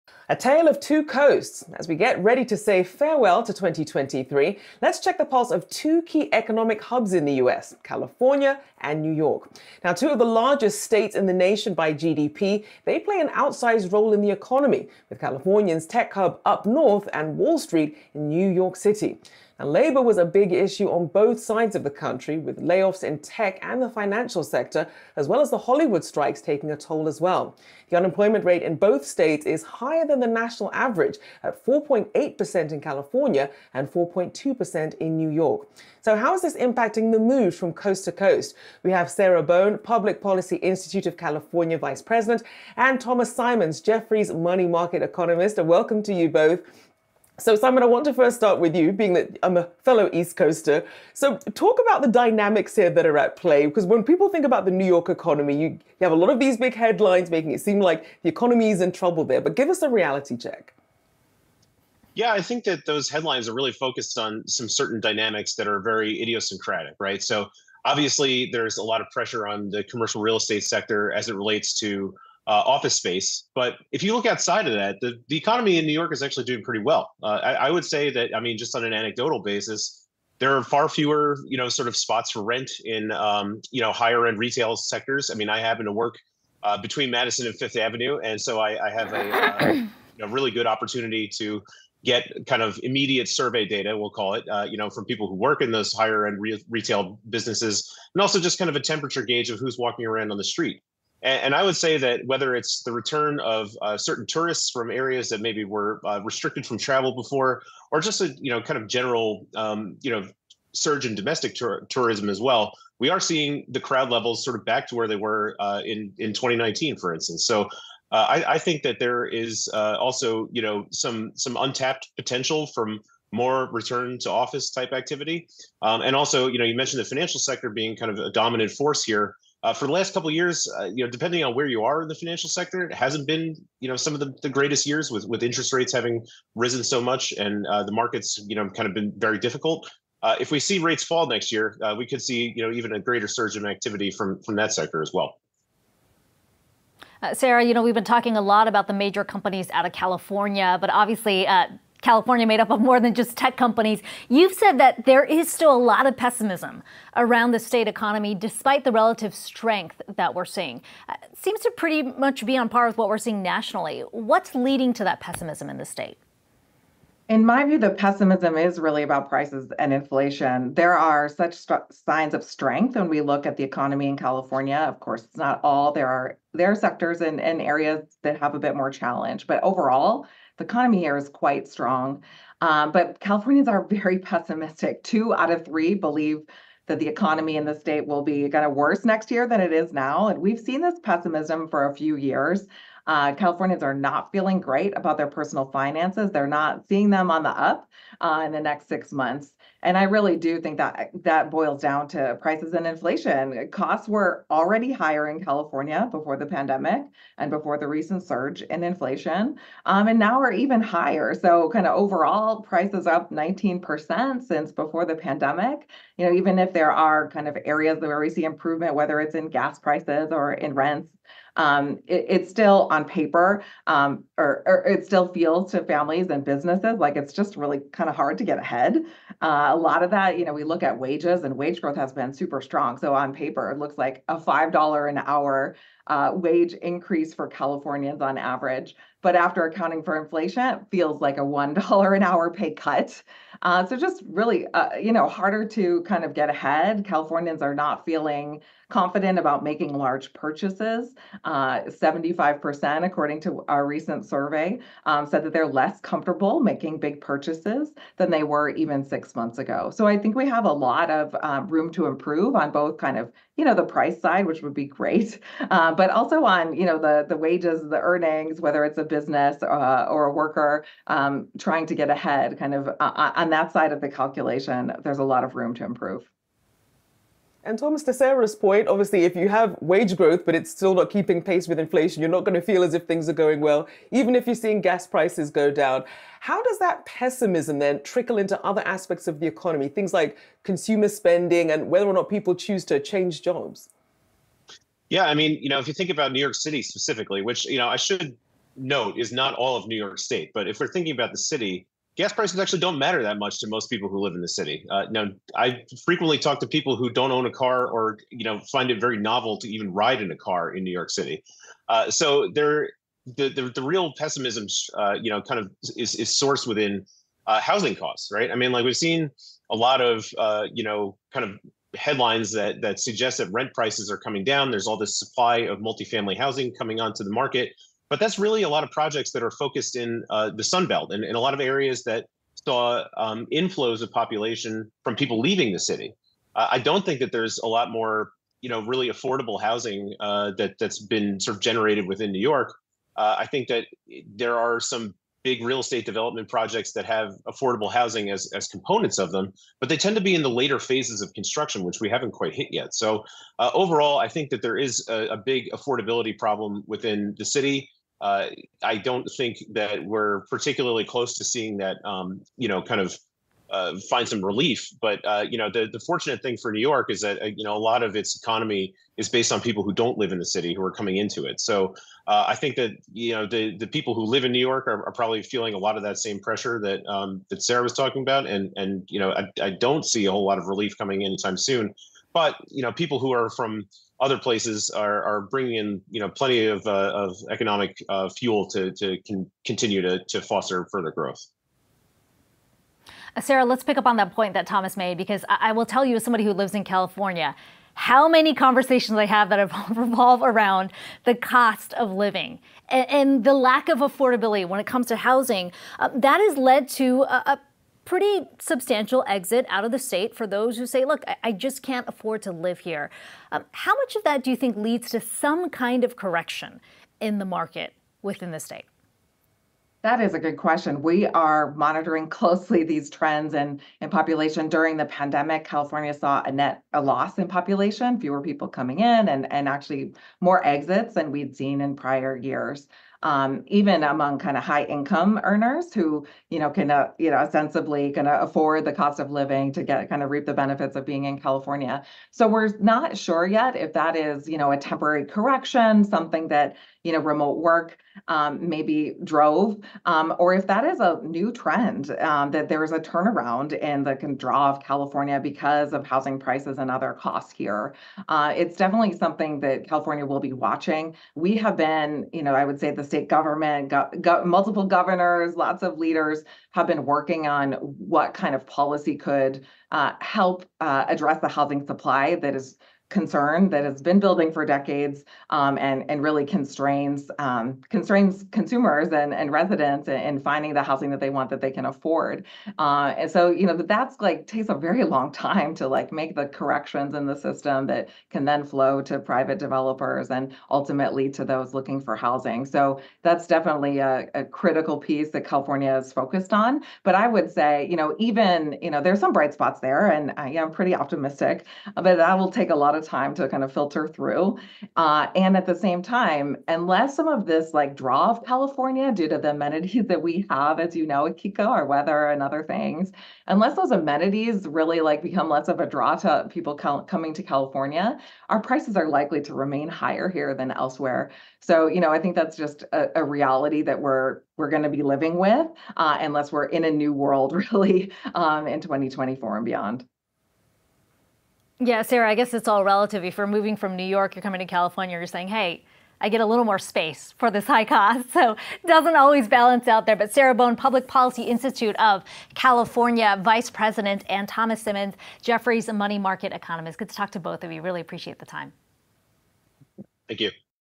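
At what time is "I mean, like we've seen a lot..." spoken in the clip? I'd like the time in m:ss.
5:18.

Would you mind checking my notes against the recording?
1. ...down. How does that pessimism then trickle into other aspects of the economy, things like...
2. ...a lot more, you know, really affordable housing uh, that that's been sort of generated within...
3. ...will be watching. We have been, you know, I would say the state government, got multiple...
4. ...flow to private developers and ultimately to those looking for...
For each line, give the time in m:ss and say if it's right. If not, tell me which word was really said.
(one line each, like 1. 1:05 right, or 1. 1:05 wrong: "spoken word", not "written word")
1. 4:45 right
2. 5:37 right
3. 7:40 right
4. 8:08 right.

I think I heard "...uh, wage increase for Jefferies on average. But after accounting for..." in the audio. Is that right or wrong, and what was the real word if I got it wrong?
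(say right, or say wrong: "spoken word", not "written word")
wrong: "Californians", not "Jefferies".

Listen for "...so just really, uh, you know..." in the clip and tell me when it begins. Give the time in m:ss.
4:03.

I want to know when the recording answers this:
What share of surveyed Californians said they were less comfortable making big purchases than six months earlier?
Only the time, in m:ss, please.
4:11.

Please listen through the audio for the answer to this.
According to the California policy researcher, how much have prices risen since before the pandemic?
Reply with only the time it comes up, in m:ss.
3:33.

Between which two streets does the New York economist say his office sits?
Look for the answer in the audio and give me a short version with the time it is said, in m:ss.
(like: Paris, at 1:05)
Madison and Fifth Avenue, at 1:27.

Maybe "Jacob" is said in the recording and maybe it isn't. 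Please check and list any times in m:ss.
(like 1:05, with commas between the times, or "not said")
not said.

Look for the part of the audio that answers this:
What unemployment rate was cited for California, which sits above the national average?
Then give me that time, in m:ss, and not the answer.
0:31.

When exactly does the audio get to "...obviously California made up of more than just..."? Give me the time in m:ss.
2:30.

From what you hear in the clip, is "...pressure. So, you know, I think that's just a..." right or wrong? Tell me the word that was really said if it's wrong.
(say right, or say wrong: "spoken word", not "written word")
wrong: "elsewhere", not "pressure".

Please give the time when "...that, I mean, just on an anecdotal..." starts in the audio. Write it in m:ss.
1:18.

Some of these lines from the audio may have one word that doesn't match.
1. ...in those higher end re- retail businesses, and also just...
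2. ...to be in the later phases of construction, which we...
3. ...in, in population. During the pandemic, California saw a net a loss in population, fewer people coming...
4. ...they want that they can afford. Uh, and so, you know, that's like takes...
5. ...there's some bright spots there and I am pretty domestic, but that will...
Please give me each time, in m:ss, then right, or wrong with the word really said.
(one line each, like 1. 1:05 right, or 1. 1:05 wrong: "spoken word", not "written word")
1. 1:35 right
2. 5:50 right
3. 7:03 right
4. 8:01 right
5. 8:19 wrong: "optimistic", not "domestic".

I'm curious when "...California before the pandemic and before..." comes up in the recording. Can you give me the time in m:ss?
3:25.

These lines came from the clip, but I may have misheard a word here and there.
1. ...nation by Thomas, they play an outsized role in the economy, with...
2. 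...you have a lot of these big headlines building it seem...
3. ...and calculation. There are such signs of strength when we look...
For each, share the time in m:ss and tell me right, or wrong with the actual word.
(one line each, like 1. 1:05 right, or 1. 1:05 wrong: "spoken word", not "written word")
1. 0:11 wrong: "GDP", not "Thomas"
2. 0:55 wrong: "making", not "building"
3. 2:49 wrong: "inflation", not "calculation".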